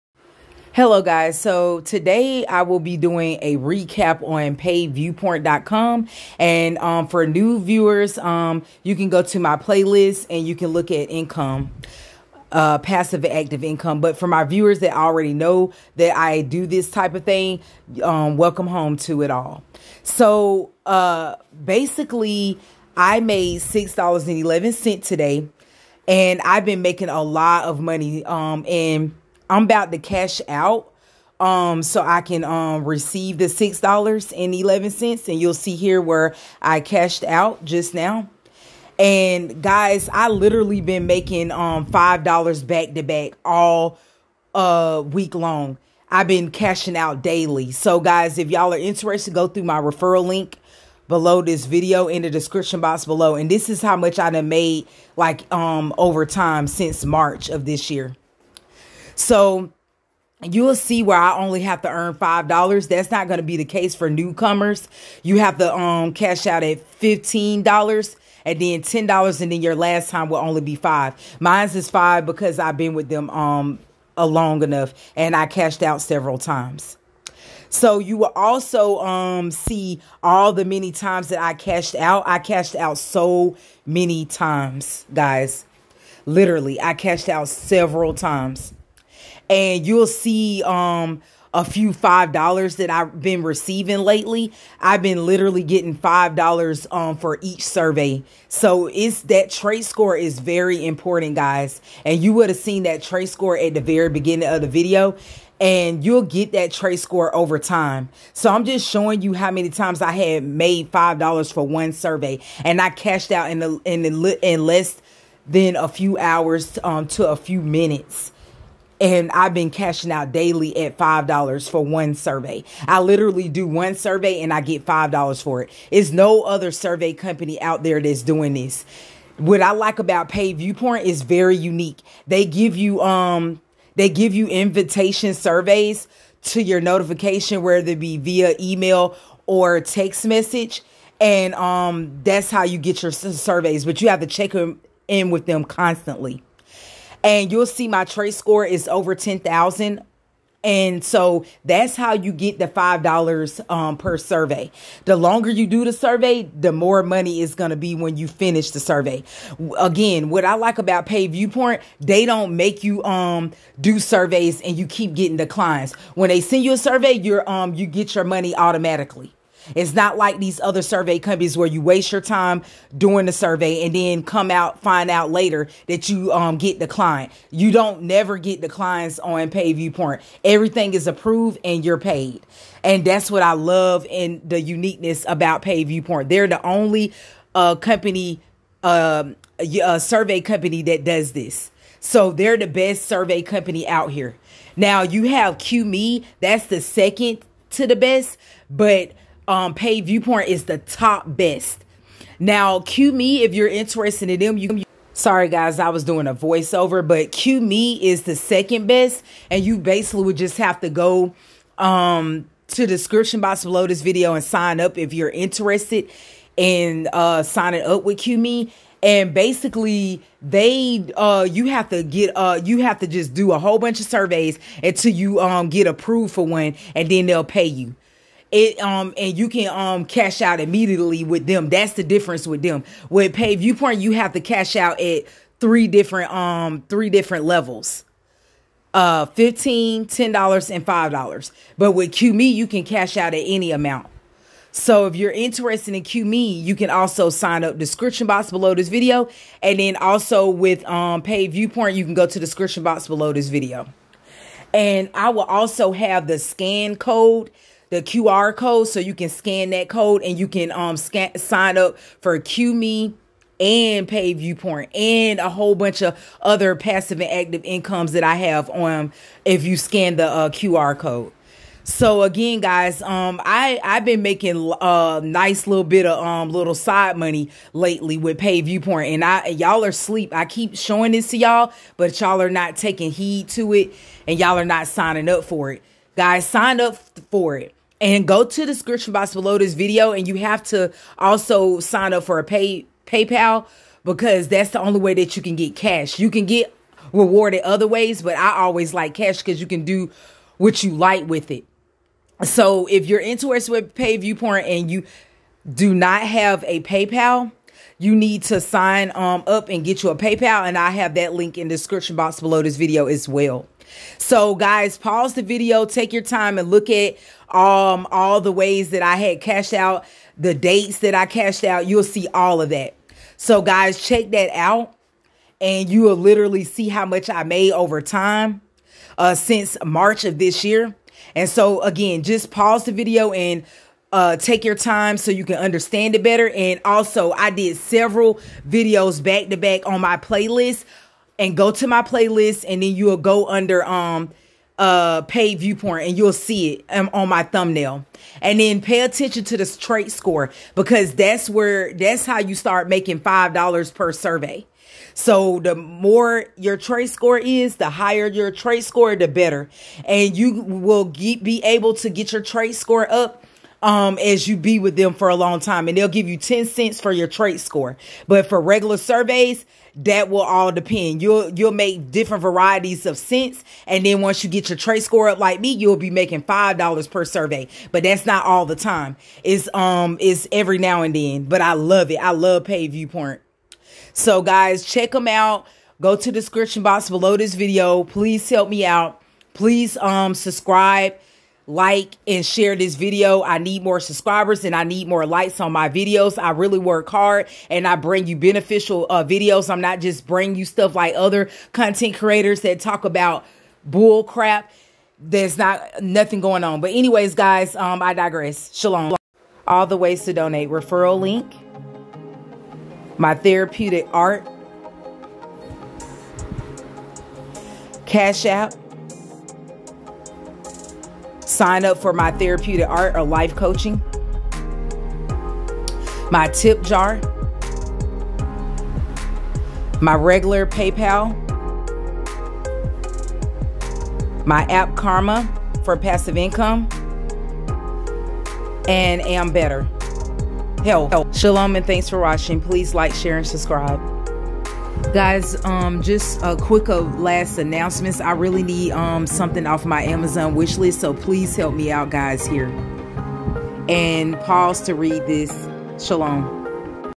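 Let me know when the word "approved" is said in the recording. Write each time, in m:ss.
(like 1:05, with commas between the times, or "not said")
3:01, 3:45.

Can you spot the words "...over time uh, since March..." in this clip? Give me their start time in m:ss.
5:27.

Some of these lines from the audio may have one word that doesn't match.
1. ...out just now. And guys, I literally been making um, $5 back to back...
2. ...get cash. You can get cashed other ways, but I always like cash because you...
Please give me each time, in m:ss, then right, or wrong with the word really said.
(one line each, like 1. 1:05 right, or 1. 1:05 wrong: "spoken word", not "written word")
1. 0:37 right
2. 4:55 wrong: "rewarded", not "cashed".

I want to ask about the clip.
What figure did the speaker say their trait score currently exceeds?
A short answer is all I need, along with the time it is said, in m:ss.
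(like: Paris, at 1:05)
10,000, at 2:28.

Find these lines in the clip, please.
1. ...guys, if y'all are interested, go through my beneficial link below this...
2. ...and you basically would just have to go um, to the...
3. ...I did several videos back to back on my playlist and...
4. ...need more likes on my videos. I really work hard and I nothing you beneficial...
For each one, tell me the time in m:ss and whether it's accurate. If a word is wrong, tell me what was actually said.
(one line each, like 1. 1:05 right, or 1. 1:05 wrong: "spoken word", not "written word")
1. 0:47 wrong: "referral", not "beneficial"
2. 3:29 right
3. 5:37 right
4. 6:34 wrong: "bring", not "nothing".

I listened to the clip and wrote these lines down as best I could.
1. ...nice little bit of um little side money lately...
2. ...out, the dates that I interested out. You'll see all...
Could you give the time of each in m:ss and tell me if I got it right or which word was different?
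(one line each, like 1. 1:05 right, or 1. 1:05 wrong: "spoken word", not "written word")
1. 4:35 right
2. 5:19 wrong: "cashed", not "interested".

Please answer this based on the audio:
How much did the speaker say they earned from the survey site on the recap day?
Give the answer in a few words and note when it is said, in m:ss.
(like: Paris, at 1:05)
$6.11, at 0:23.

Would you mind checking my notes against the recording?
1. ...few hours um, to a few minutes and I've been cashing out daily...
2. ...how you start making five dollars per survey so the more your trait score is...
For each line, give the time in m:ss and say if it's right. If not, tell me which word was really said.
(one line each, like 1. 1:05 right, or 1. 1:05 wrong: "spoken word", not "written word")
1. 1:55 right
2. 5:52 right.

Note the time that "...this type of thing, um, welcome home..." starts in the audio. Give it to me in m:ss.
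0:16.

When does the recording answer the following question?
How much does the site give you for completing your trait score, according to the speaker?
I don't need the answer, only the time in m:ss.
6:06.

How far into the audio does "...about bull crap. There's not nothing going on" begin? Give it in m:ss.
6:43.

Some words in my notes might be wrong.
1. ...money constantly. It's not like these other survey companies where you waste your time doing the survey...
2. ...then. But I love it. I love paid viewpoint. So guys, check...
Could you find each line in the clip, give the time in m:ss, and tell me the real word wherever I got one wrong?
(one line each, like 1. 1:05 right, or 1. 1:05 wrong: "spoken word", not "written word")
1. 2:48 wrong: "automatically", not "constantly"
2. 6:21 right.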